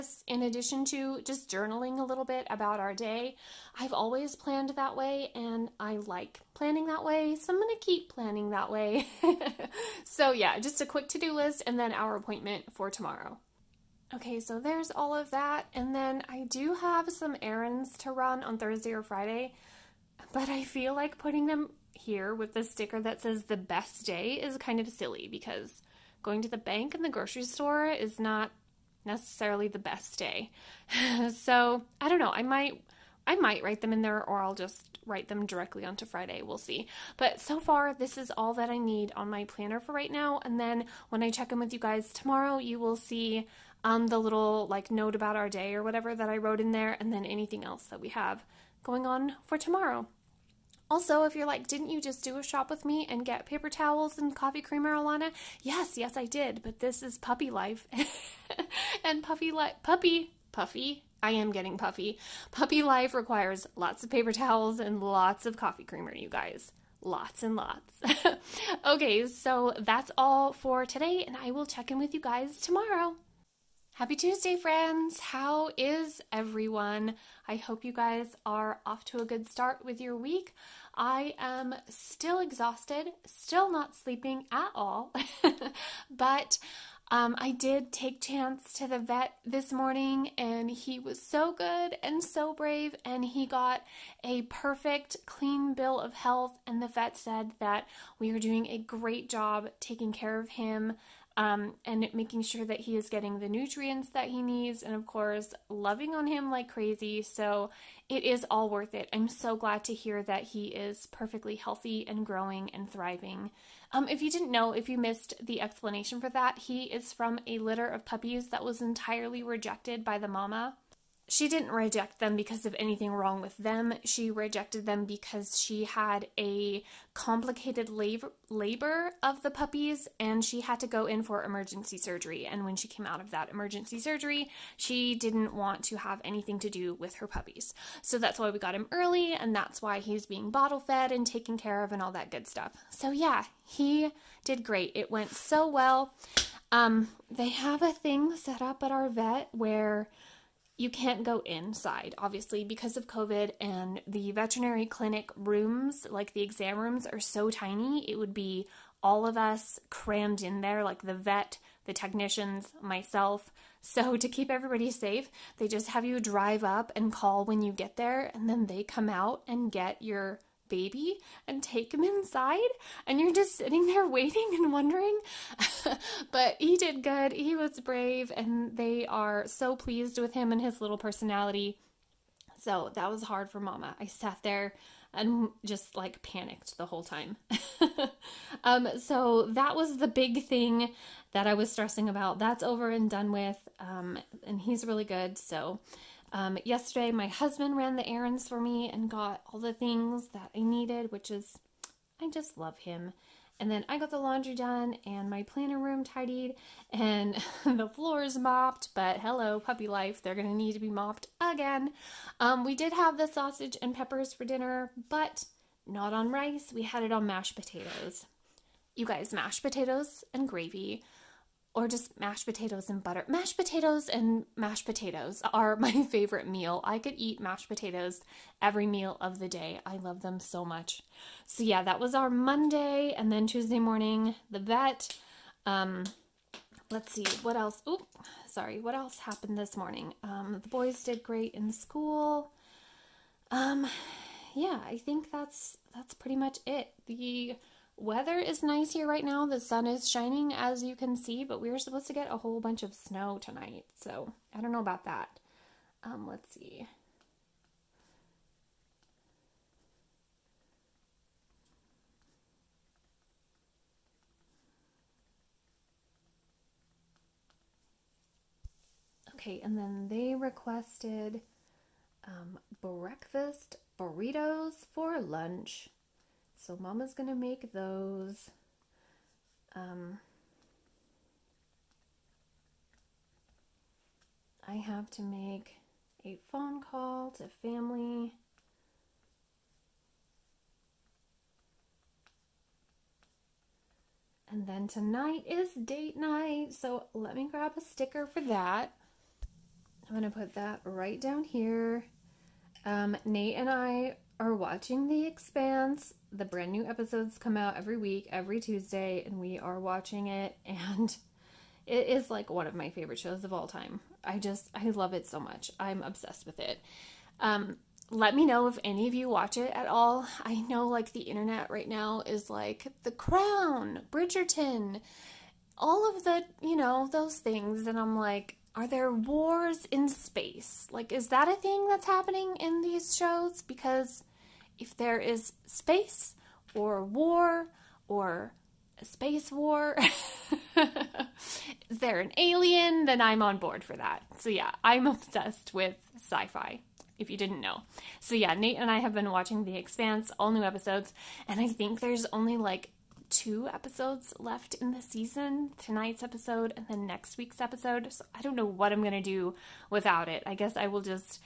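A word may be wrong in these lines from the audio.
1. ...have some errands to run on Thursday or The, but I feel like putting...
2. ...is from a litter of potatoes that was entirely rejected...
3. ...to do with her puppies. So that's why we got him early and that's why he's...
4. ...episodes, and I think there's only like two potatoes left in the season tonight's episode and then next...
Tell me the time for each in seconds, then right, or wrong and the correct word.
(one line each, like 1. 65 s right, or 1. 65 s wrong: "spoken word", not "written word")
1. 16 s wrong: "Friday", not "The"
2. 116 s wrong: "puppies", not "potatoes"
3. 136 s right
4. 350 s wrong: "episodes", not "potatoes".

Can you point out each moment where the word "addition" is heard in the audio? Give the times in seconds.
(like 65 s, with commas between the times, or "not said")
0 s.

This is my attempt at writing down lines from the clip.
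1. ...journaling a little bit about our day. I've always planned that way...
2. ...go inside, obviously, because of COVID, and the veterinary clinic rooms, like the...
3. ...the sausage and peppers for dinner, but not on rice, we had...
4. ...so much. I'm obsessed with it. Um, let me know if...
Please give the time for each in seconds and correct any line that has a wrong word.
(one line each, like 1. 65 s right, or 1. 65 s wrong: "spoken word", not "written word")
1. 1 s right
2. 151 s right
3. 213 s right
4. 315 s right.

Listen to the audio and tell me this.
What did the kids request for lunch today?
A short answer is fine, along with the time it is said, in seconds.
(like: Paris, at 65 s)
breakfast burritos, at 272 s.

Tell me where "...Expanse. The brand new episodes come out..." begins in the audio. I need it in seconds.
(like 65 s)
305 s.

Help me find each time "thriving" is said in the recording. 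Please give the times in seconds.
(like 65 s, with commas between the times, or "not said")
112 s.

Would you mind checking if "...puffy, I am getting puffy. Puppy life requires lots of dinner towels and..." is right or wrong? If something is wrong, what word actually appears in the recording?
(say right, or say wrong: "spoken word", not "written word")
wrong: "paper", not "dinner".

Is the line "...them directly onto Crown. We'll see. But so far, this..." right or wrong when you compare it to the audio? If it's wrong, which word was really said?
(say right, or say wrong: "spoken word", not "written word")
wrong: "Friday", not "Crown".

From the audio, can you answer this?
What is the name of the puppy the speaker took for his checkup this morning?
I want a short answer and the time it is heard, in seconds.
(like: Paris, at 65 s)
Chance, at 88 s.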